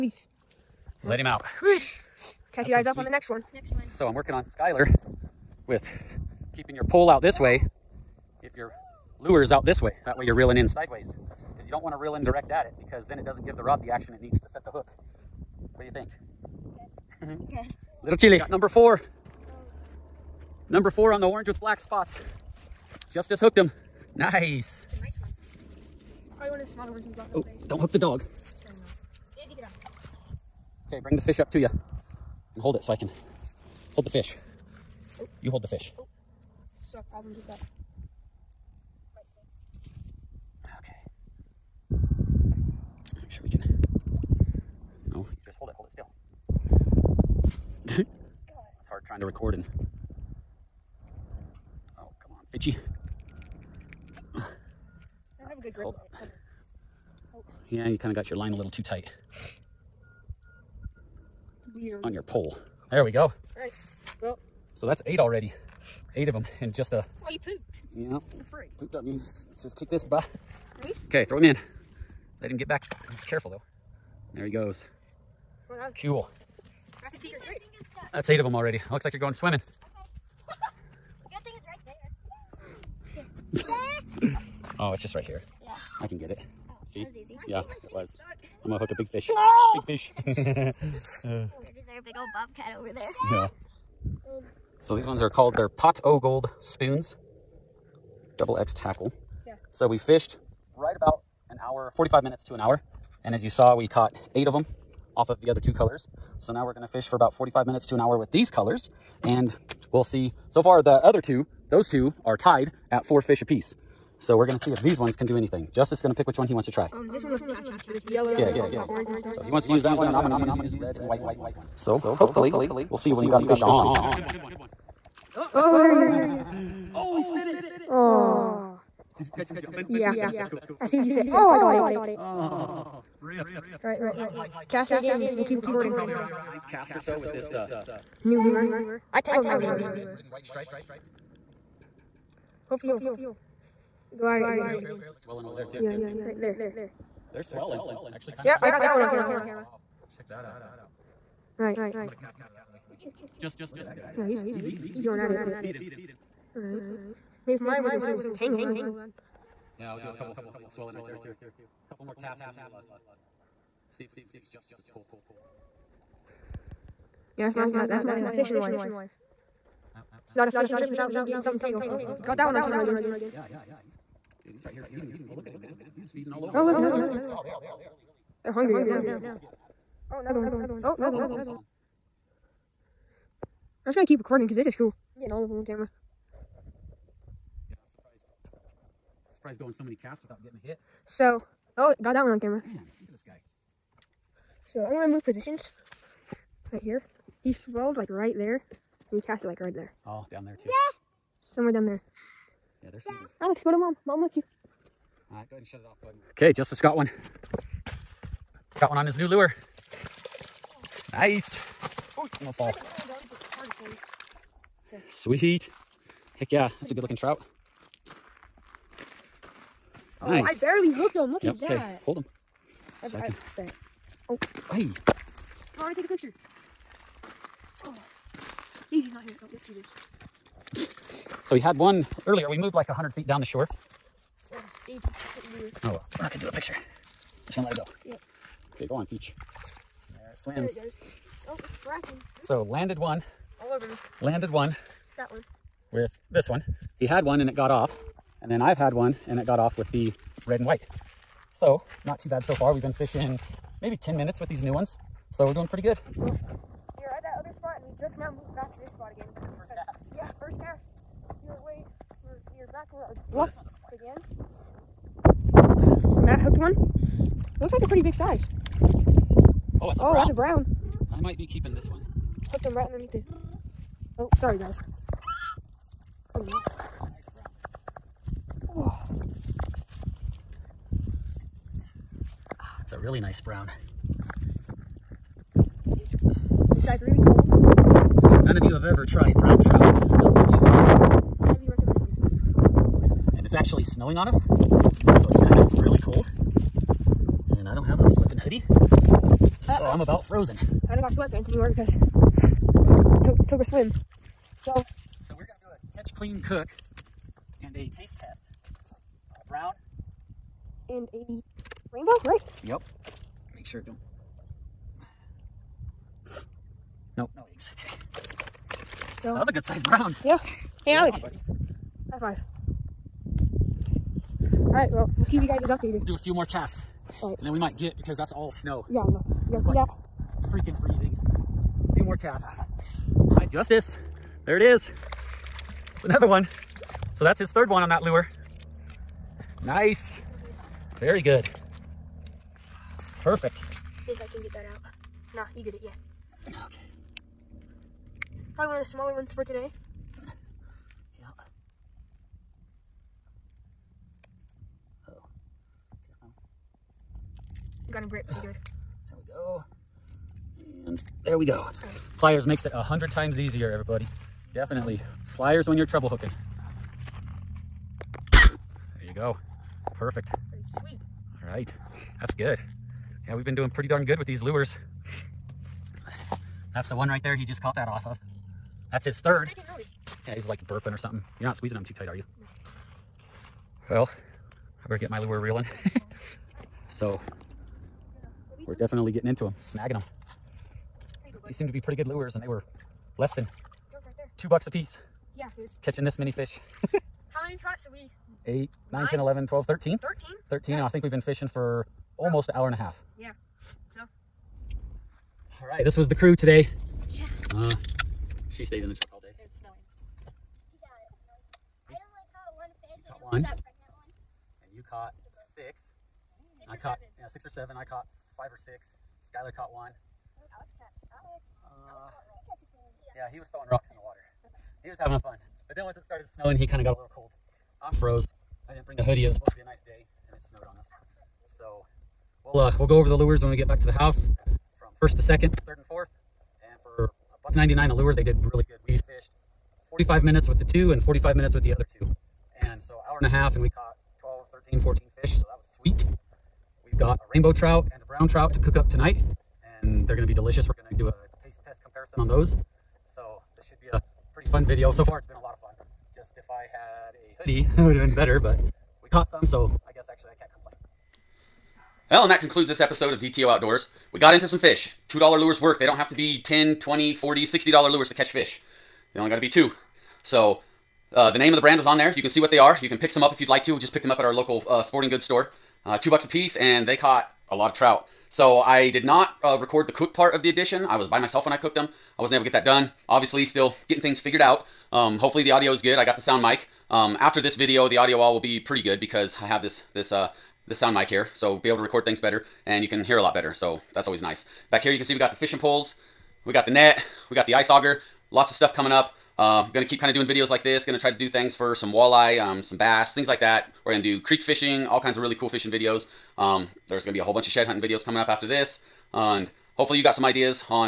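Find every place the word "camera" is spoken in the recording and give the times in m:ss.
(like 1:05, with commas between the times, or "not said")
2:29, 2:52, 3:05, 3:12.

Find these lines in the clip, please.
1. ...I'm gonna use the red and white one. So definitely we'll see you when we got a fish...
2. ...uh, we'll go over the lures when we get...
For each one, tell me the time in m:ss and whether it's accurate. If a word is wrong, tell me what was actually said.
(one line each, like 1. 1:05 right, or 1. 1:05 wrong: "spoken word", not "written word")
1. 2:00 wrong: "hopefully", not "definitely"
2. 7:12 right.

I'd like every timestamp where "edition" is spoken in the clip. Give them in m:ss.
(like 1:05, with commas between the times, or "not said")
8:00.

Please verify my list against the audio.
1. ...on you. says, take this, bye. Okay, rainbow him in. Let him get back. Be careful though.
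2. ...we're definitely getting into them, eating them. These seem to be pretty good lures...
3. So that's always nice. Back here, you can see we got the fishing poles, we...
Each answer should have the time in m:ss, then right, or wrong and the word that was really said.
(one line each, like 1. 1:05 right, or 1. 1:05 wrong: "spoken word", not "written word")
1. 1:08 wrong: "throw", not "rainbow"
2. 6:28 wrong: "snagging", not "eating"
3. 8:13 right.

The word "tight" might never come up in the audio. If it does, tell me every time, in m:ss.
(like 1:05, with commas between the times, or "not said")
0:58, 6:21.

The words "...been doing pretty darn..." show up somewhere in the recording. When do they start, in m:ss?
6:13.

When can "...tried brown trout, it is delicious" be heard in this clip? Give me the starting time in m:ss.
4:49.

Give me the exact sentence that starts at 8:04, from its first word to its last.
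Um, hopefully the audio is good.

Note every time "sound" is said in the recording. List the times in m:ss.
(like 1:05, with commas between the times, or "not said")
8:06, 8:10.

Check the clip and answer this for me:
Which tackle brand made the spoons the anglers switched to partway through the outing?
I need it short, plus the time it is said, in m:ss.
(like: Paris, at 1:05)
Double X tackle, at 1:38.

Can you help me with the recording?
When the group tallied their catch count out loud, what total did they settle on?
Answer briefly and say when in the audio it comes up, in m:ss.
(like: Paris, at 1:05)
13, at 6:40.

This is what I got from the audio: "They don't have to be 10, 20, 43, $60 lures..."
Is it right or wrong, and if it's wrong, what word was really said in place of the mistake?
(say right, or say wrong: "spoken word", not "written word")
wrong: "40", not "43".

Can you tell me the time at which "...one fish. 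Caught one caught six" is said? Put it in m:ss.
6:52.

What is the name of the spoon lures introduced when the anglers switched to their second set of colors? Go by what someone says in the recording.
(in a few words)
Pot o gold spoons.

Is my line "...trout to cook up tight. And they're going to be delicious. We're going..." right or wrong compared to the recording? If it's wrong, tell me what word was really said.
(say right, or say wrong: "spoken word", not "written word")
wrong: "tonight", not "tight".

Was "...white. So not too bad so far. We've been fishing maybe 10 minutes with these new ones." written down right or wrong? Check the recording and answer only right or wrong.
right.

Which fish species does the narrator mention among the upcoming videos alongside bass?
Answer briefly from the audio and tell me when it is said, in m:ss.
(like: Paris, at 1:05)
walleye, at 8:21.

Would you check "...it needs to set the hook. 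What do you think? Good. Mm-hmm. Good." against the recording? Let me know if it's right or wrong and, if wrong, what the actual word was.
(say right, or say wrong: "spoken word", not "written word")
right.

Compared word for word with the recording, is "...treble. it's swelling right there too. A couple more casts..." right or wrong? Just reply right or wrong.
wrong.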